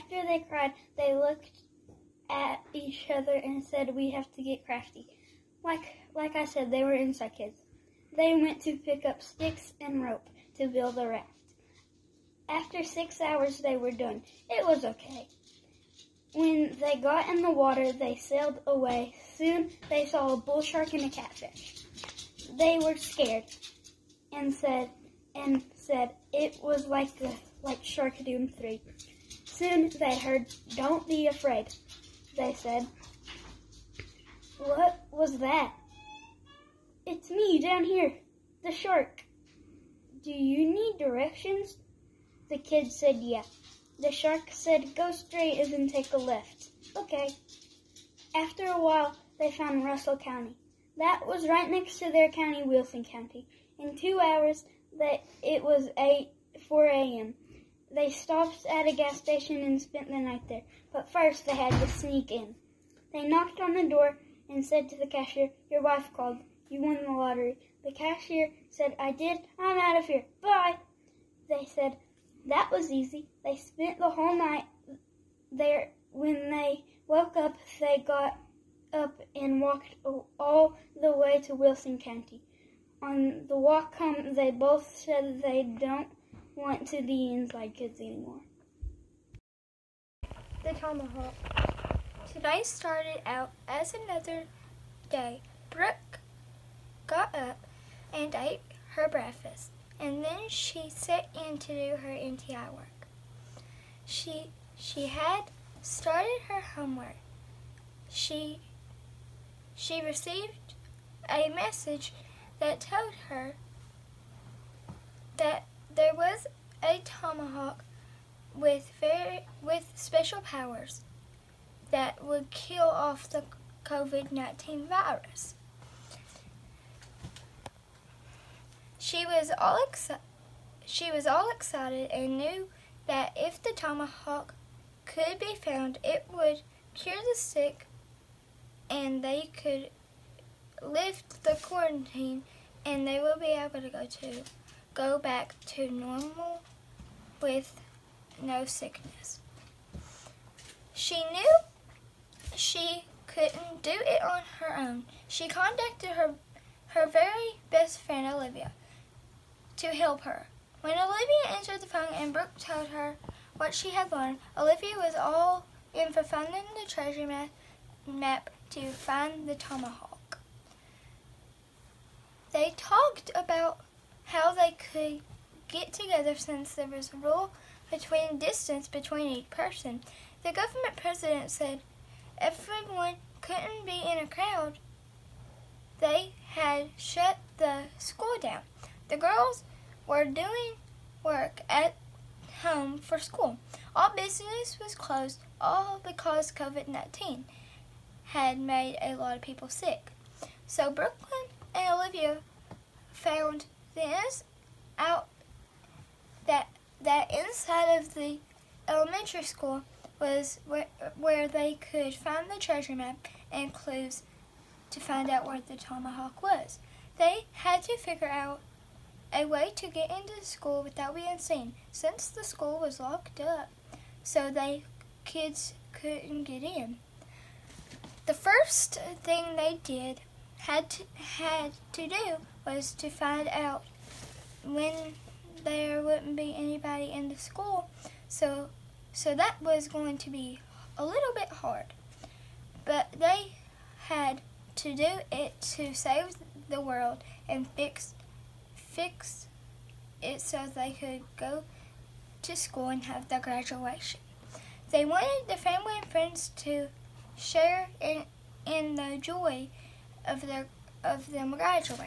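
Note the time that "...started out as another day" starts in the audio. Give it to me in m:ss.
1:32.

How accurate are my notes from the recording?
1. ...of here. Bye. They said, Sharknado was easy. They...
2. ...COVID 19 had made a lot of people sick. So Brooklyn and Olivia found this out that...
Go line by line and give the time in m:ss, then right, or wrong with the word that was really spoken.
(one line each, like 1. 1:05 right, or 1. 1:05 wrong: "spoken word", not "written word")
1. 1:09 wrong: "That", not "Sharknado"
2. 3:16 right.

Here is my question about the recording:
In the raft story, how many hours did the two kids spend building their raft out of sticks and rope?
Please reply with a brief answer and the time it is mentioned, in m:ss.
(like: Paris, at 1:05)
6, at 0:12.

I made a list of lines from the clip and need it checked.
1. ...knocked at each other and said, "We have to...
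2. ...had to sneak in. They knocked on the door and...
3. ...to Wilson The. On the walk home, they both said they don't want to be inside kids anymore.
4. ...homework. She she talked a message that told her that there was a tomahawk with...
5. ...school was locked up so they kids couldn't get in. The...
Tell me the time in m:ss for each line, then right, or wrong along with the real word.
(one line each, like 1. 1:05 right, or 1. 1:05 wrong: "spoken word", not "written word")
1. 0:01 wrong: "looked", not "knocked"
2. 1:01 right
3. 1:21 wrong: "County", not "The"
4. 1:46 wrong: "received", not "talked"
5. 3:42 right.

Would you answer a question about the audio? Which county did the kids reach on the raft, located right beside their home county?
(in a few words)
Russell County.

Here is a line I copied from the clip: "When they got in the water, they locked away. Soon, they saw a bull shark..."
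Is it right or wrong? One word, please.
wrong.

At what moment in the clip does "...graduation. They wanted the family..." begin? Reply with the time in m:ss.
4:13.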